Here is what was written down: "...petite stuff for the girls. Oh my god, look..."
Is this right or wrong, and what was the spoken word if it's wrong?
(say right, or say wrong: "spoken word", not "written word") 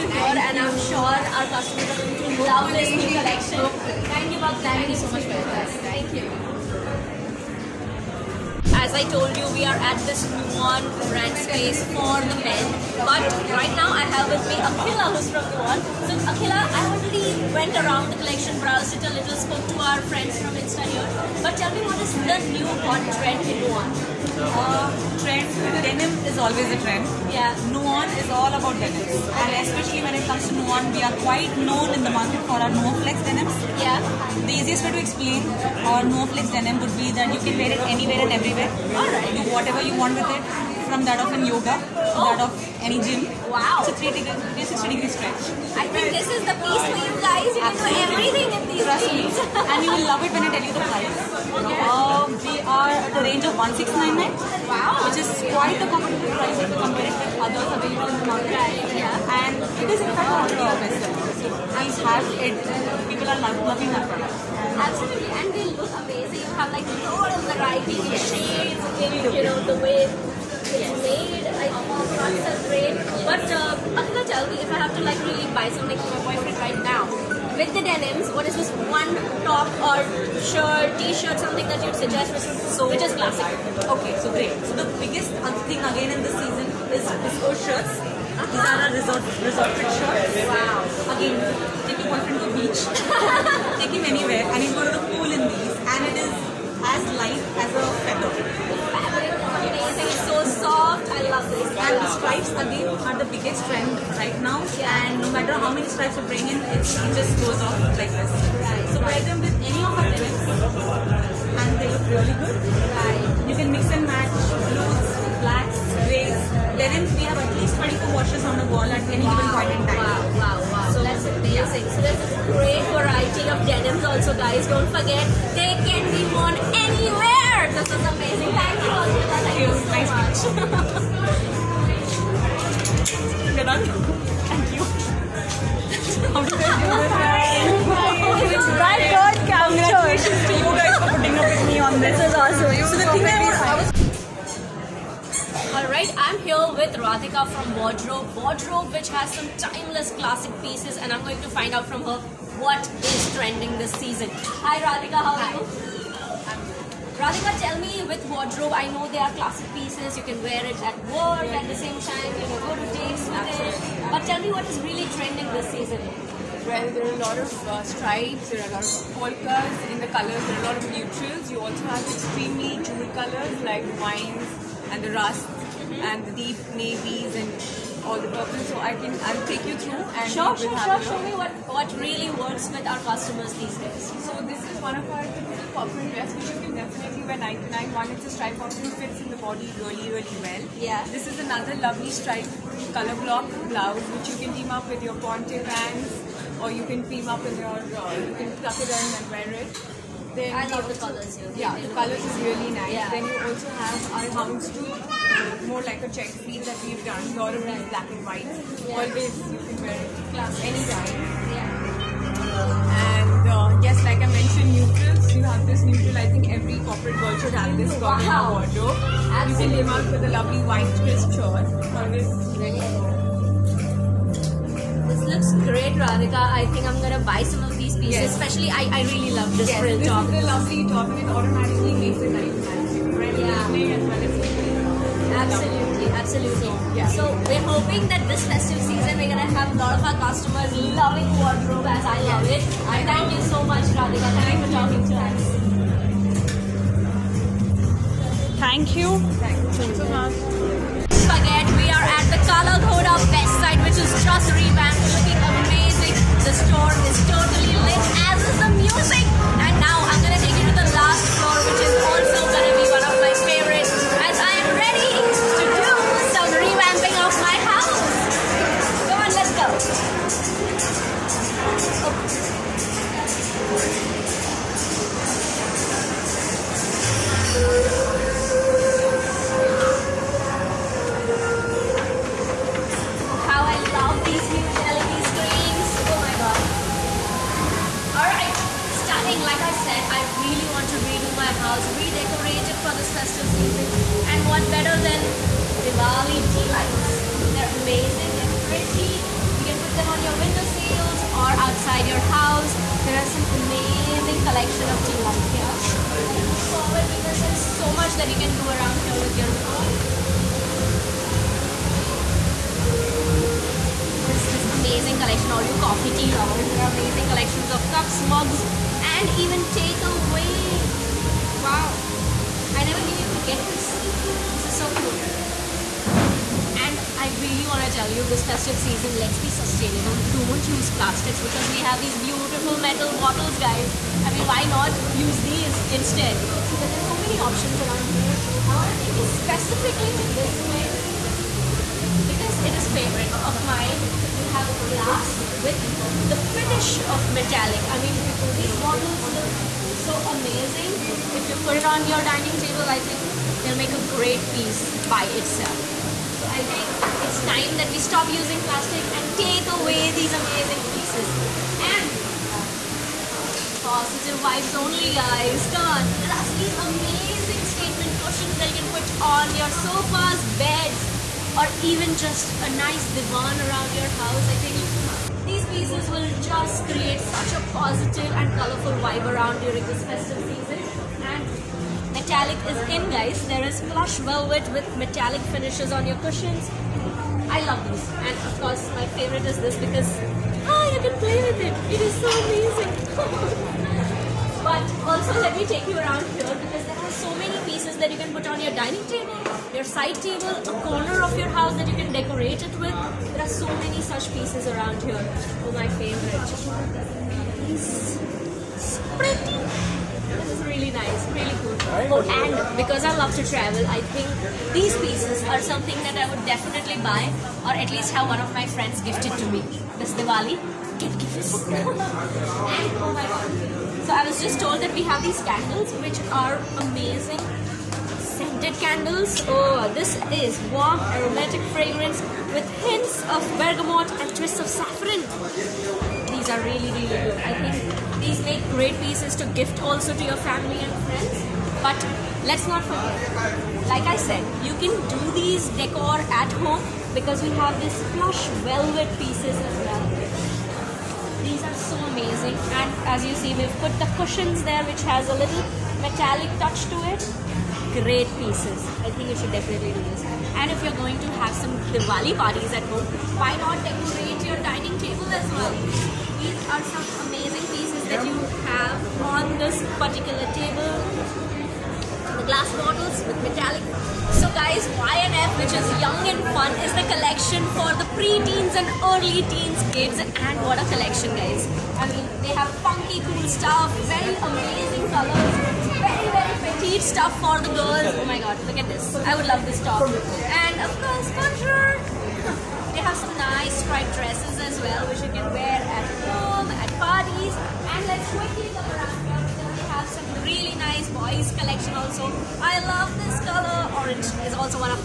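right.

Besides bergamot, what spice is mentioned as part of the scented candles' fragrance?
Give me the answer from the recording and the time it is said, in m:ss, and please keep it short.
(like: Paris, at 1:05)
saffron, at 7:14.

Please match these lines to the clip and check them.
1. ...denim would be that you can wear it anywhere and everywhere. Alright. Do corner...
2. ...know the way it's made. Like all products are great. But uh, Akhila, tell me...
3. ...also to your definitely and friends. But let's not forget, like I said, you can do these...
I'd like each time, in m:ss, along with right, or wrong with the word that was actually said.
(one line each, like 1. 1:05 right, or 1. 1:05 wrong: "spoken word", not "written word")
1. 0:36 wrong: "whatever", not "corner"
2. 1:09 right
3. 7:19 wrong: "family", not "definitely".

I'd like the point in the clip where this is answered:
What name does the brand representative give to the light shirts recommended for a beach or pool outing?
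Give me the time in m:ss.
1:29.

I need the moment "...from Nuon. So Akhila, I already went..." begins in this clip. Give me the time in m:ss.
0:15.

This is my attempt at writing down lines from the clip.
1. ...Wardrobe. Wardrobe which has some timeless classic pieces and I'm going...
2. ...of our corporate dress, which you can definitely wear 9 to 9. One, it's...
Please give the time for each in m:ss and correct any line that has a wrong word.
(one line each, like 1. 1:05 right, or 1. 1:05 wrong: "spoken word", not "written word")
1. 2:27 right
2. 3:04 right.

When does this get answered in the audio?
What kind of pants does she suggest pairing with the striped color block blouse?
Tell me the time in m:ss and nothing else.
3:15.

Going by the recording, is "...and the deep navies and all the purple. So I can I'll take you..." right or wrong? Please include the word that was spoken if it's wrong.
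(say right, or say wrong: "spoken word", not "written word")
right.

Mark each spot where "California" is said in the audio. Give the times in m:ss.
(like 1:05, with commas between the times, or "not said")
not said.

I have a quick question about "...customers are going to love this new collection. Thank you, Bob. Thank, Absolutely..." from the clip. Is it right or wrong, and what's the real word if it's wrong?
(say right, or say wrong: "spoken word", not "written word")
wrong: "Thank", not "Absolutely".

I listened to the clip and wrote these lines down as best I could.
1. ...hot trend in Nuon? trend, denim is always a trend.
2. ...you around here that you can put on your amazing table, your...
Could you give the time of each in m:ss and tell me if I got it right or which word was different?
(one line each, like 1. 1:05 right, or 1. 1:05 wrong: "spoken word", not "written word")
1. 0:22 right
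2. 6:35 wrong: "dining", not "amazing".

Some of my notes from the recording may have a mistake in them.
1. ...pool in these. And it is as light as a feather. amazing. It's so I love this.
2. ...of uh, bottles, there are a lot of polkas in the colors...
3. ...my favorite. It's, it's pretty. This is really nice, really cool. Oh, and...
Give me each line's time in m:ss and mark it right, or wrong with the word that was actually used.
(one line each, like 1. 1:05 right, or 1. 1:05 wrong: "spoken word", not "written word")
1. 1:35 right
2. 2:47 wrong: "stripes", not "bottles"
3. 6:45 right.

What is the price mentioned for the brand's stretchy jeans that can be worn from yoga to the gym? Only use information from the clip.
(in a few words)
1699.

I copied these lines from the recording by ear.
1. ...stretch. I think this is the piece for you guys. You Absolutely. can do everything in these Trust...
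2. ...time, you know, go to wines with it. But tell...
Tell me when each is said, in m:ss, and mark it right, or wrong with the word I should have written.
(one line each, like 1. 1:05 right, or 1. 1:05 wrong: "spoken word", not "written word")
1. 0:45 right
2. 2:42 wrong: "dates", not "wines".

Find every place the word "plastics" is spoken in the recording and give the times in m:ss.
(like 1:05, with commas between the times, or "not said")
5:30, 5:58.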